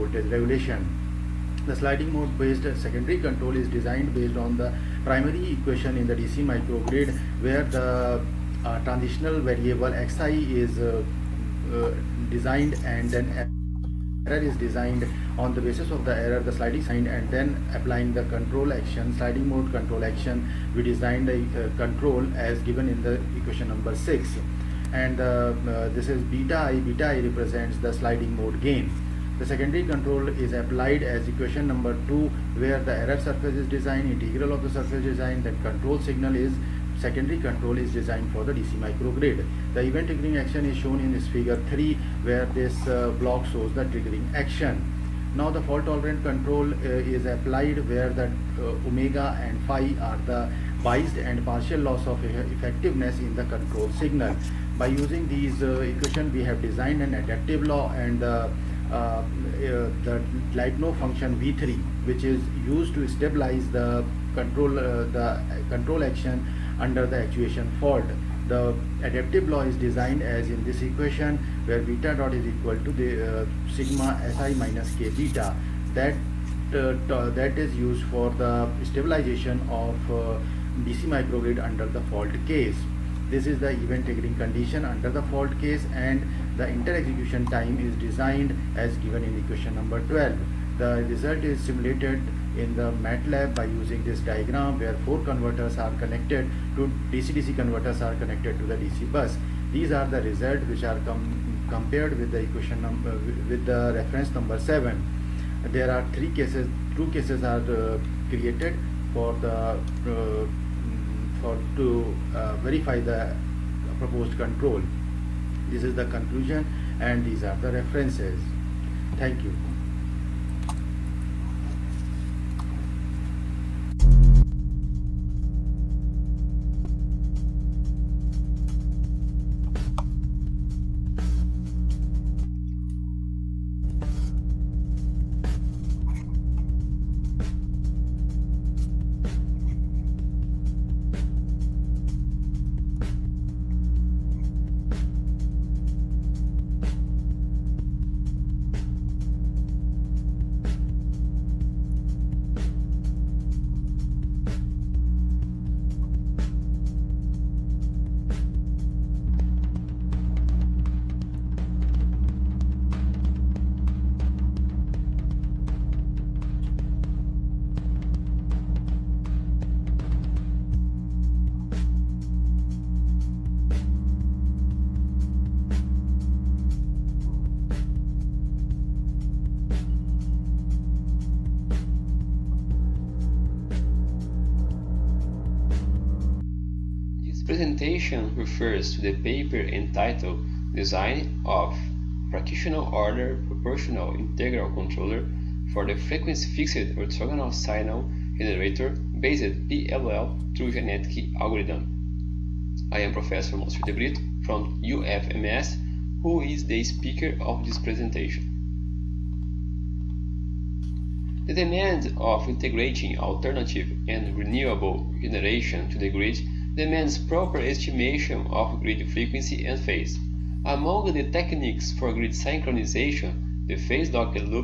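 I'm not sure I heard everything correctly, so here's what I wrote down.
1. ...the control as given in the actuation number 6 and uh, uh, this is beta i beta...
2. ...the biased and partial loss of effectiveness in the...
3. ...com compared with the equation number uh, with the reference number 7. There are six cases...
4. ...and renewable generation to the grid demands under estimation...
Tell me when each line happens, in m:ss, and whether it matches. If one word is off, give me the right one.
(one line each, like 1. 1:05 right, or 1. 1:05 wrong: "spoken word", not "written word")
1. 0:21 wrong: "equation", not "actuation"
2. 0:50 right
3. 1:41 wrong: "three", not "six"
4. 3:34 wrong: "proper", not "under".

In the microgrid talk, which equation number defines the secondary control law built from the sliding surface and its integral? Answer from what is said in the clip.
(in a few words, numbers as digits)
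2.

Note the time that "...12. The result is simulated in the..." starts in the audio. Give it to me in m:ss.
1:30.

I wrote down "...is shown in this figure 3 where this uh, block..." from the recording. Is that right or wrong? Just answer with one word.
right.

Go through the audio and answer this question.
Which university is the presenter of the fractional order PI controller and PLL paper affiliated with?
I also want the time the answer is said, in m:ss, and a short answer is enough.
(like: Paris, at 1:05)
UFMS, at 3:24.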